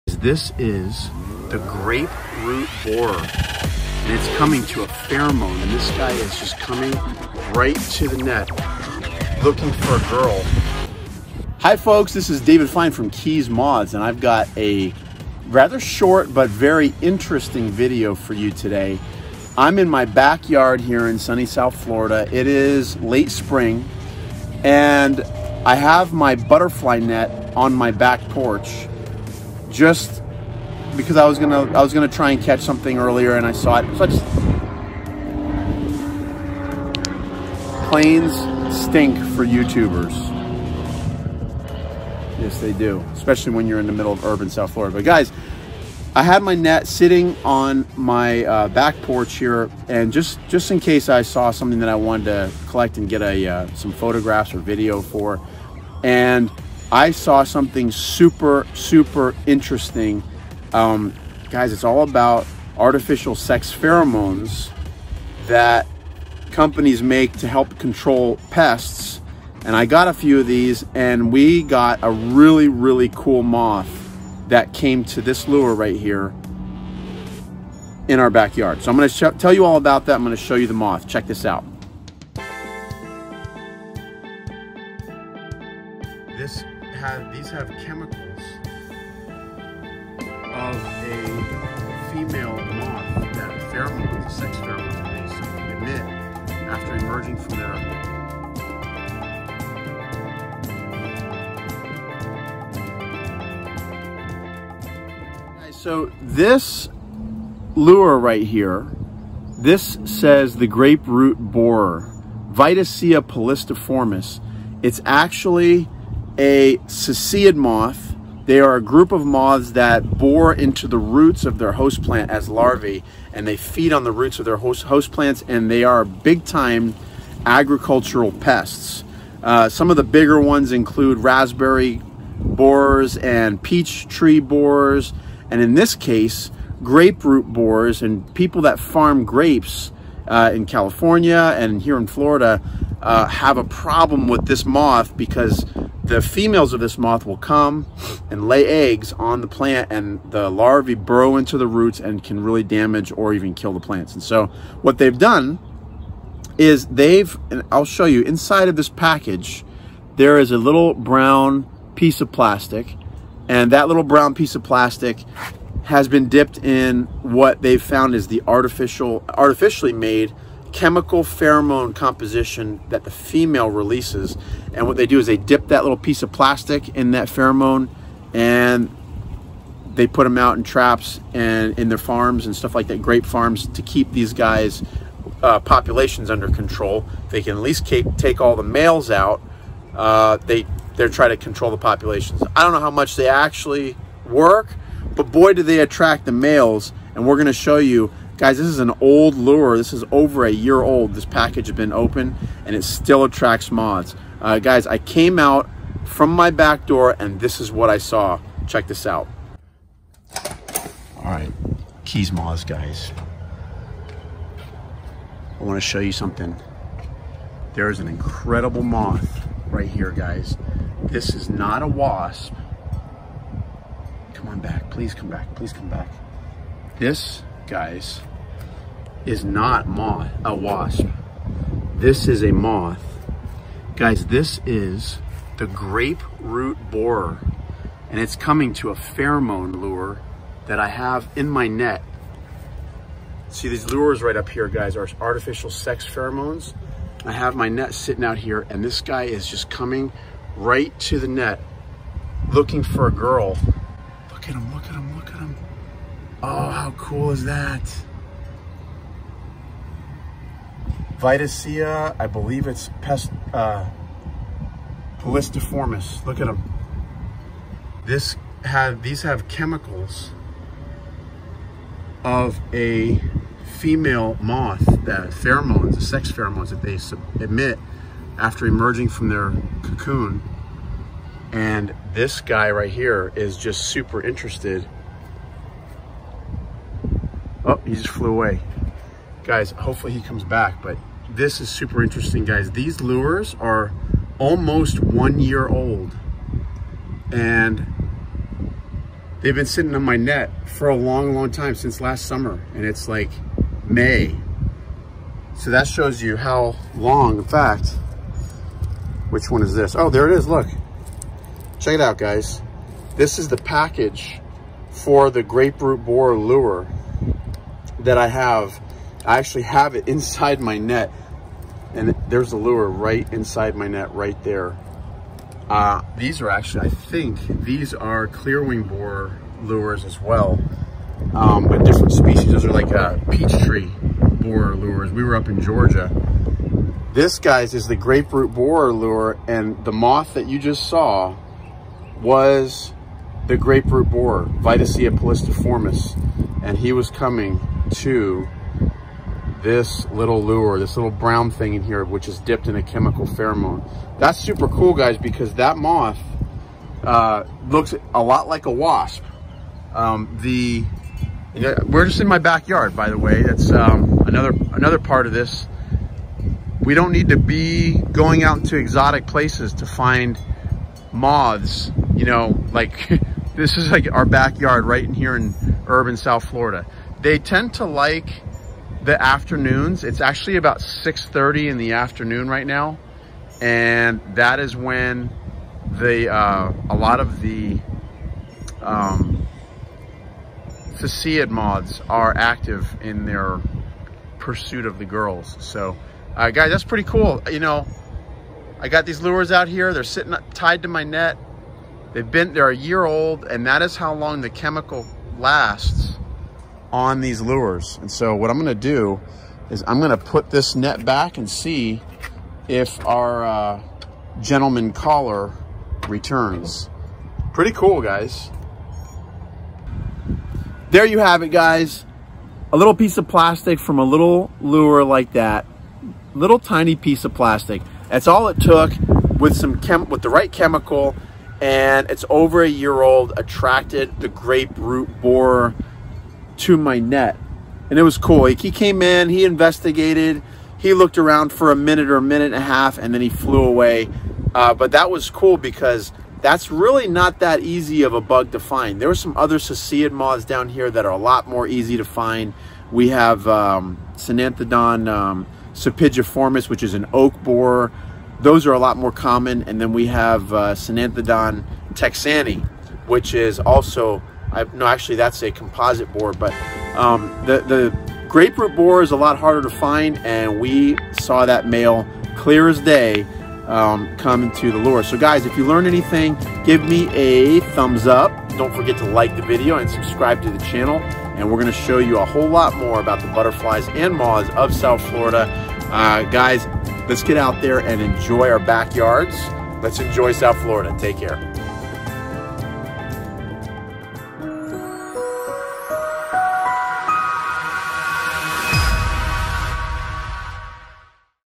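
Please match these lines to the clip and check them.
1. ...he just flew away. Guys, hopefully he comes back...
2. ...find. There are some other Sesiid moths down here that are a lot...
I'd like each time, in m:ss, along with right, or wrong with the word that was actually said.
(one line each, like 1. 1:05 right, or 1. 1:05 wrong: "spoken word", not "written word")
1. 4:47 right
2. 7:28 right.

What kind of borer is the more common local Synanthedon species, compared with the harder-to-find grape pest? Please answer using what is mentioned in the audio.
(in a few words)
oak borer.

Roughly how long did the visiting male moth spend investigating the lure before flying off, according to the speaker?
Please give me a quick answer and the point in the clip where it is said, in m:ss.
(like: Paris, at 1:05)
a minute and a half, at 7:22.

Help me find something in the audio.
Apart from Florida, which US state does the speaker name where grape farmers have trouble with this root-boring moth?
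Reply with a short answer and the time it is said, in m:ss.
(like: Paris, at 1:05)
California, at 2:20.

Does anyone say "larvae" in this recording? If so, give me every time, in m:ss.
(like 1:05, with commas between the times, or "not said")
2:02, 2:30.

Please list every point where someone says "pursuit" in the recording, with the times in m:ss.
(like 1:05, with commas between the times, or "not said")
6:34.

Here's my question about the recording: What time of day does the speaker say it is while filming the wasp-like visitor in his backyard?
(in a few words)
6:30 in the afternoon.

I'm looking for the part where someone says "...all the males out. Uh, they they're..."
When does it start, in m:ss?
3:08.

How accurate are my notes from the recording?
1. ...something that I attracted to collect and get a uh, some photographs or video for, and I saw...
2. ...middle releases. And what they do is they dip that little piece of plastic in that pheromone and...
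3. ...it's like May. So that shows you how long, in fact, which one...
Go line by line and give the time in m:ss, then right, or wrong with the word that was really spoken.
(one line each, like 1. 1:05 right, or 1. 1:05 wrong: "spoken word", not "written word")
1. 0:51 wrong: "wanted", not "attracted"
2. 2:53 wrong: "female", not "middle"
3. 5:02 right.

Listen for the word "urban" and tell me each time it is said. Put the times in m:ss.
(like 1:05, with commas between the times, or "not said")
0:44, 6:15.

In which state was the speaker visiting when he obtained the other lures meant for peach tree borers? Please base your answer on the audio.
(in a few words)
Georgia.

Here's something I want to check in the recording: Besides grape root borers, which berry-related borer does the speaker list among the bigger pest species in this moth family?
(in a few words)
raspberry borers.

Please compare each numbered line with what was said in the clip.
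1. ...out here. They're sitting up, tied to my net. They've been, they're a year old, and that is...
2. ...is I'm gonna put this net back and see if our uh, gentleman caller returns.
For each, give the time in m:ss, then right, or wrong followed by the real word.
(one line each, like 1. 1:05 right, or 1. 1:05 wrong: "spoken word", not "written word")
1. 6:39 right
2. 6:49 right.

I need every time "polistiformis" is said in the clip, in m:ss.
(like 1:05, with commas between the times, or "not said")
1:53, 4:25, 5:45.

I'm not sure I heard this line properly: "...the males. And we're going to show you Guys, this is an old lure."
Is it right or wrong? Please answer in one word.
right.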